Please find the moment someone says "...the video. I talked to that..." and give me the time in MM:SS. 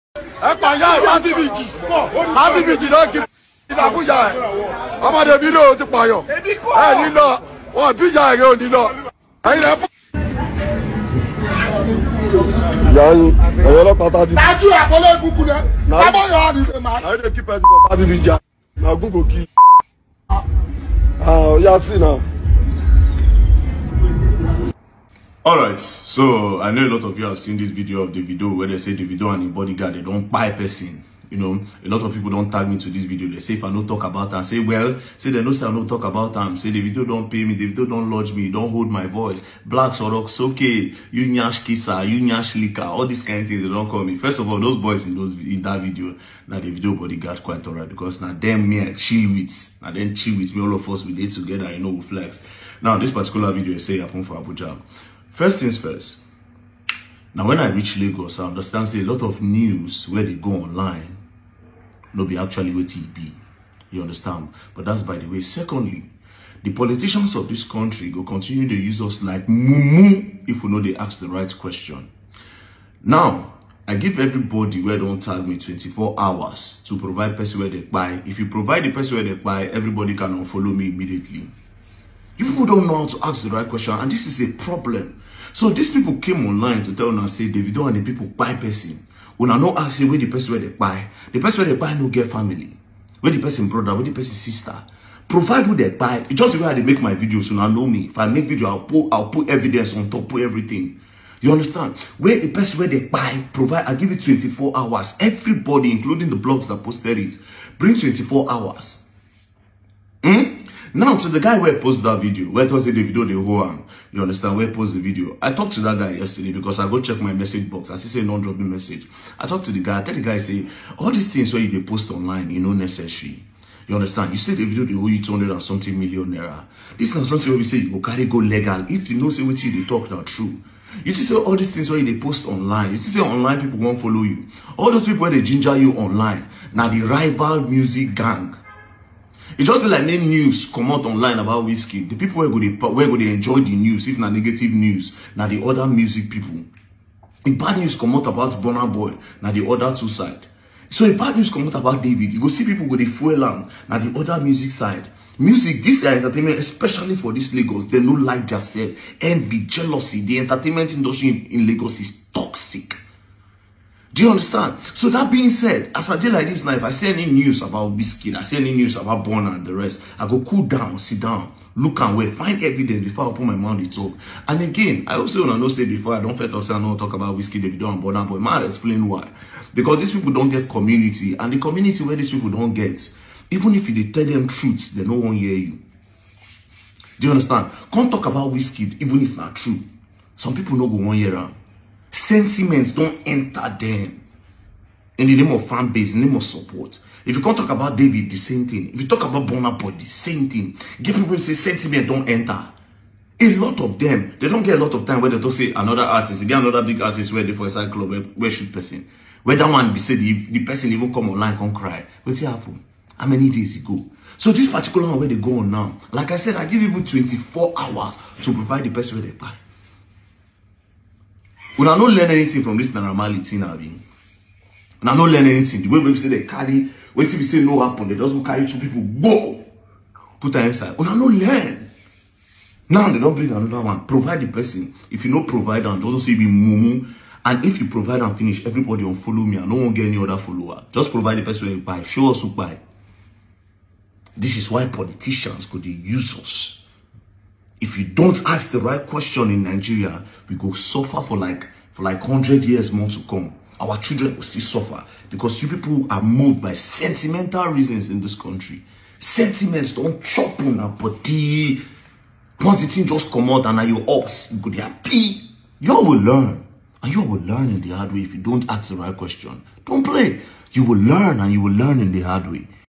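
01:55.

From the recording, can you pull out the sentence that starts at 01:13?
Now, I give everybody where don't tag me 24 hours to provide person where they buy.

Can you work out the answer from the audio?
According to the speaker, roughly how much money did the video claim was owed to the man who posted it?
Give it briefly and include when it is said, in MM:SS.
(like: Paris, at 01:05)
200 and something million naira, at 02:05.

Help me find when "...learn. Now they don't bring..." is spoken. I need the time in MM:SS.
03:51.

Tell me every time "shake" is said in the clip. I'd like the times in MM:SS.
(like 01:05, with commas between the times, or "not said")
not said.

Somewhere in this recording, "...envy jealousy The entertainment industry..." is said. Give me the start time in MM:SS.
02:39.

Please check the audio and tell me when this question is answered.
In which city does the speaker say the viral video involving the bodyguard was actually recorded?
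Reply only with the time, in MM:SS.
00:54.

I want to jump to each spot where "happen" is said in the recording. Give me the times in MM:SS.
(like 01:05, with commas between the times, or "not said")
00:53, 03:32, 03:47.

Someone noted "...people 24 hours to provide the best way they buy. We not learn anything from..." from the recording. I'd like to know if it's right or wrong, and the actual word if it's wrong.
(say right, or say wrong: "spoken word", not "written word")
right.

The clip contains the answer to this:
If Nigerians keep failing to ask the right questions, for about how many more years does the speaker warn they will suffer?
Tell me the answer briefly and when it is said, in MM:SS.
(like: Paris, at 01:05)
100, at 04:12.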